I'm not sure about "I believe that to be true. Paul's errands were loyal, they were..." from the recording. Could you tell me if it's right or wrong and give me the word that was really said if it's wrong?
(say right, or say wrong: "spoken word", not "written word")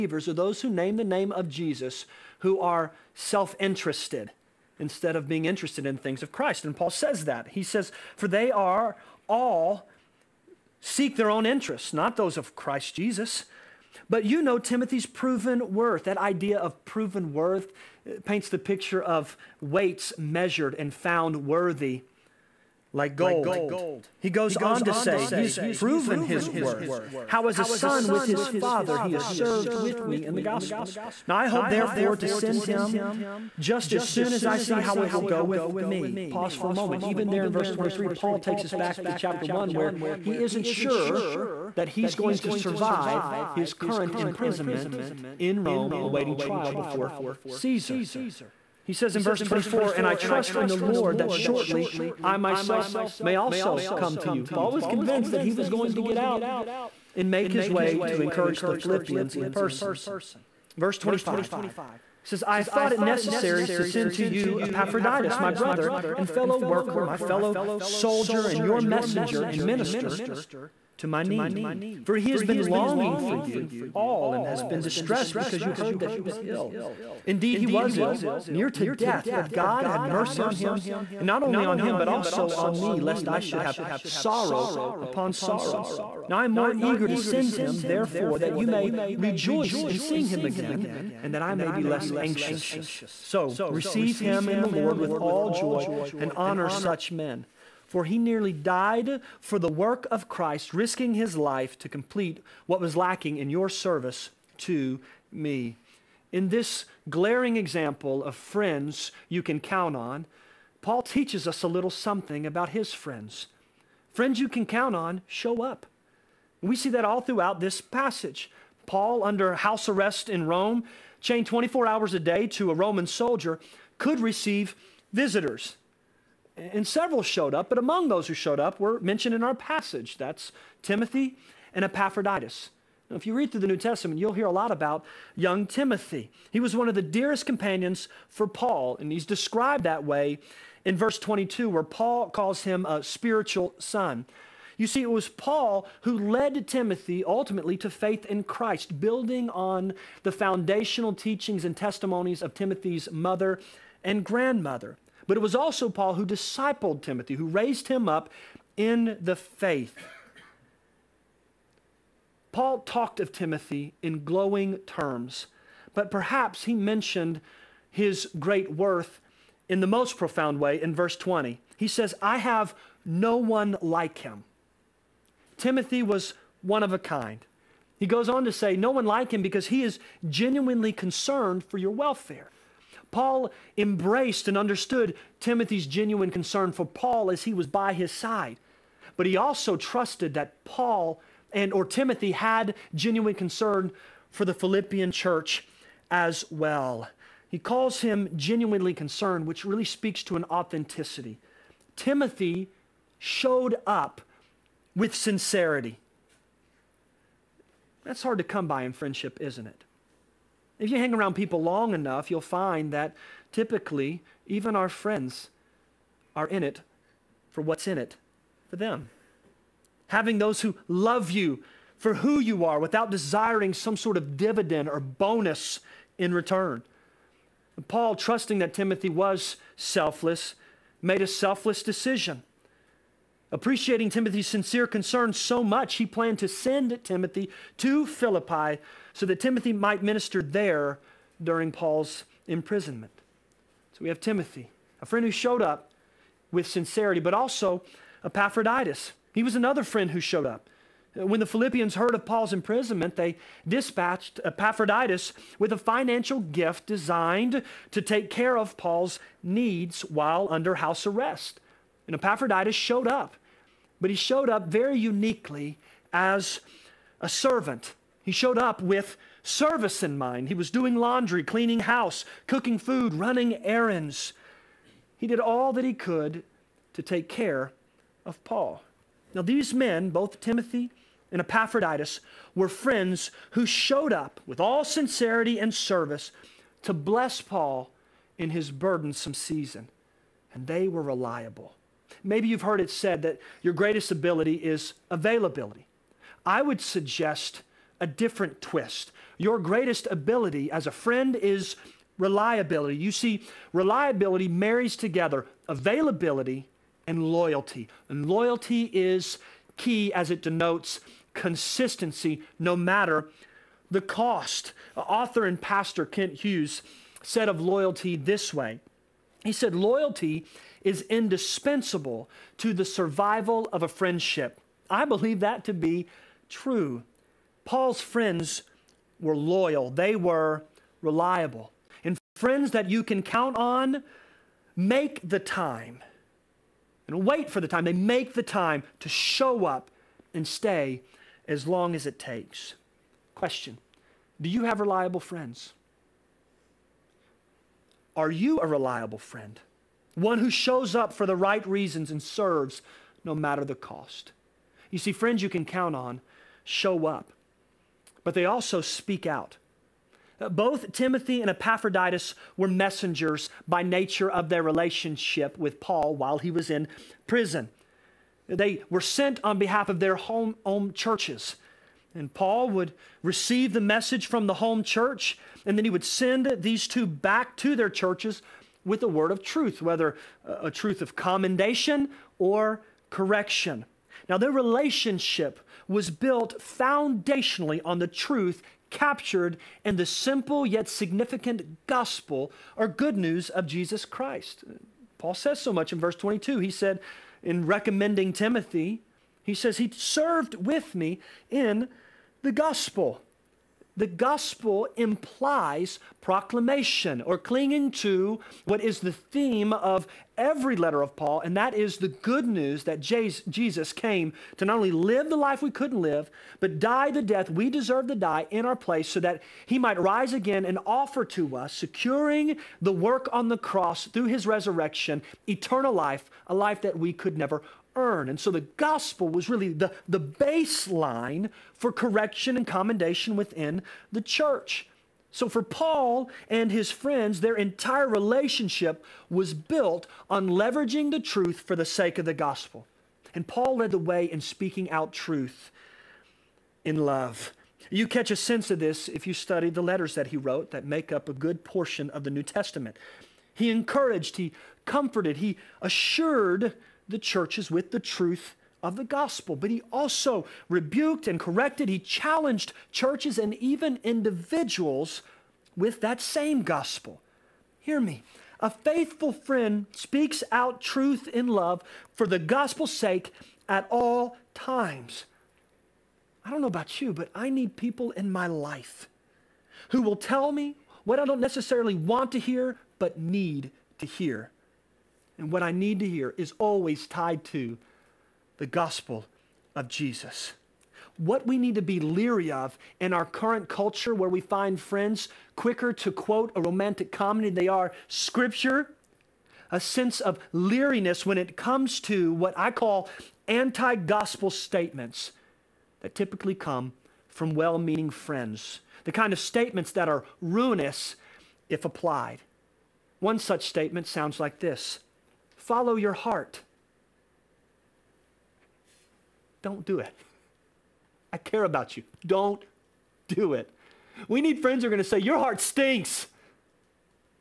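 wrong: "friends", not "errands".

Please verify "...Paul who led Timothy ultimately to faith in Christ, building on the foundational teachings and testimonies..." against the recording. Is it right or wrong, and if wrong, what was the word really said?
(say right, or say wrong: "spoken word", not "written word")
right.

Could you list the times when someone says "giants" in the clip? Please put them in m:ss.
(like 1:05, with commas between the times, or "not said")
not said.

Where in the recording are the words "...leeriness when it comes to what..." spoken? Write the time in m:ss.
8:20.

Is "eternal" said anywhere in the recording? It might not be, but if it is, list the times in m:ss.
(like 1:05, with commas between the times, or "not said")
7:05.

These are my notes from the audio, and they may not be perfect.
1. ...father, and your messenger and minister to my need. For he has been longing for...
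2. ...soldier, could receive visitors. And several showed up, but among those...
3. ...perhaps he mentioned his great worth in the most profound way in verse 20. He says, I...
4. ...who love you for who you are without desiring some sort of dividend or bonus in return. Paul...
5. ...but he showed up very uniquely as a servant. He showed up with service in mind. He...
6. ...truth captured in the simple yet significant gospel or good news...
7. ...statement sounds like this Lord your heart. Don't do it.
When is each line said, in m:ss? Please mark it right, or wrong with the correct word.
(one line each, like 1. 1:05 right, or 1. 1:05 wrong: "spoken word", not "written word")
1. 1:07 wrong: "soldier", not "father"
2. 2:03 right
3. 2:46 right
4. 3:40 right
5. 4:24 right
6. 6:28 right
7. 8:33 wrong: "Follow", not "Lord".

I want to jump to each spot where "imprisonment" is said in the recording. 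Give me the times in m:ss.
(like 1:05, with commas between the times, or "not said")
0:44, 4:02, 4:12.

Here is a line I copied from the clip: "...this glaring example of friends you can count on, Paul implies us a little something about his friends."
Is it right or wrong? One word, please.
wrong.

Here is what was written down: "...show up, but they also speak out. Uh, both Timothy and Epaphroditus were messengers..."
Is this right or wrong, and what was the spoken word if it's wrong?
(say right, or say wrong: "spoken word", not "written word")
right.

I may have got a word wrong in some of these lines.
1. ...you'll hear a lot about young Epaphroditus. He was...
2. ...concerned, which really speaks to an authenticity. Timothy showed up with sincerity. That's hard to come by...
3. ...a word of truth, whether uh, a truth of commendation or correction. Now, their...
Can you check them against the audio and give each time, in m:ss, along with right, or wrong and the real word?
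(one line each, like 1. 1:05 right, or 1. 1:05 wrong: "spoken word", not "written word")
1. 2:14 wrong: "Timothy", not "Epaphroditus"
2. 3:18 right
3. 6:19 right.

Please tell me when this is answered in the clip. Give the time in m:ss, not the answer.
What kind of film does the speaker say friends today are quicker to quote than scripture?
8:16.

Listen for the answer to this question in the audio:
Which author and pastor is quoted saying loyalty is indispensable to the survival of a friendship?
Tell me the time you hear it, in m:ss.
5:16.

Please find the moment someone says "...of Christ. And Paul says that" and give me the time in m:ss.
0:06.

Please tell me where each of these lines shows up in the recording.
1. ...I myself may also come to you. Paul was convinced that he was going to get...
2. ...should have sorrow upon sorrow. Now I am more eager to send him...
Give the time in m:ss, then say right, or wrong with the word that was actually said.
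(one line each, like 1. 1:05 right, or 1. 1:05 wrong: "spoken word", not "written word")
1. 0:52 right
2. 1:23 right.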